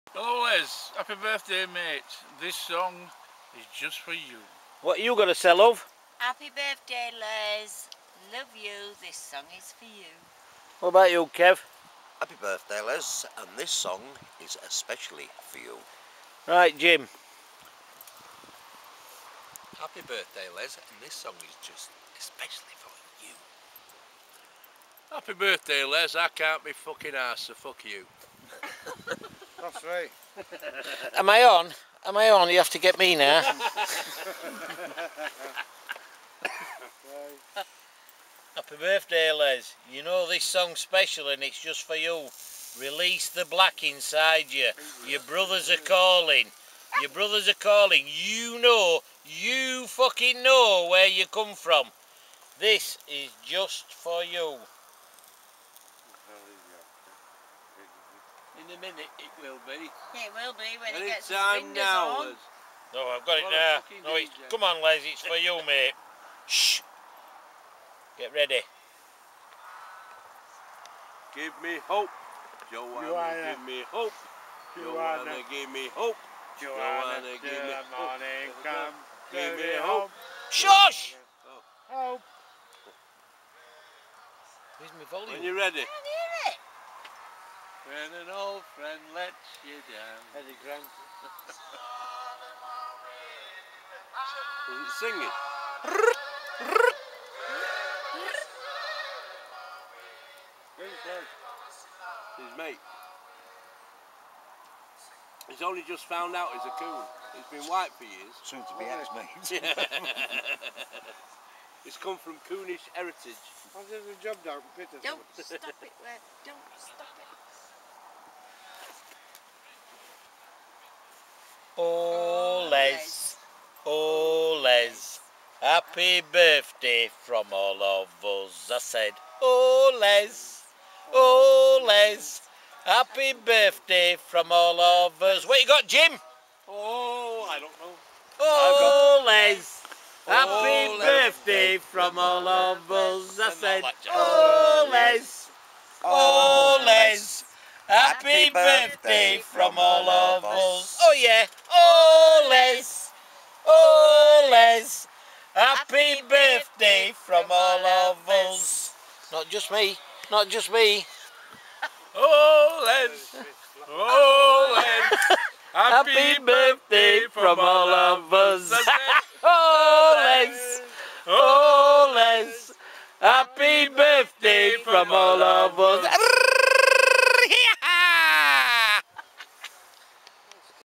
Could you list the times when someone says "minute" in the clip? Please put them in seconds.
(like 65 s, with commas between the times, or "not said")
58 s.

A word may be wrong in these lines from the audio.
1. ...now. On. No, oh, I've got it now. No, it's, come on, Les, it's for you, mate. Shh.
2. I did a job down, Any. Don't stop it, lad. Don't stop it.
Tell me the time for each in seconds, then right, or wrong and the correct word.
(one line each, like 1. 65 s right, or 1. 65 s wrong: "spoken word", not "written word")
1. 61 s right
2. 113 s wrong: "Peter", not "Any".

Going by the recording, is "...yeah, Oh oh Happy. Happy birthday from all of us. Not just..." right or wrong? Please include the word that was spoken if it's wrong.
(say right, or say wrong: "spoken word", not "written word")
wrong: "Oles", not "Happy".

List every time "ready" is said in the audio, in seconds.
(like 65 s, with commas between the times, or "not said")
68 s, 85 s.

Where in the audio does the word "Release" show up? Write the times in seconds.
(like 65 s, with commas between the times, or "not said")
42 s.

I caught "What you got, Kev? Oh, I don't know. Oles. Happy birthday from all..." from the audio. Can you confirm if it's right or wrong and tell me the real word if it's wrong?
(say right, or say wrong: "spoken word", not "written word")
wrong: "Jim", not "Kev".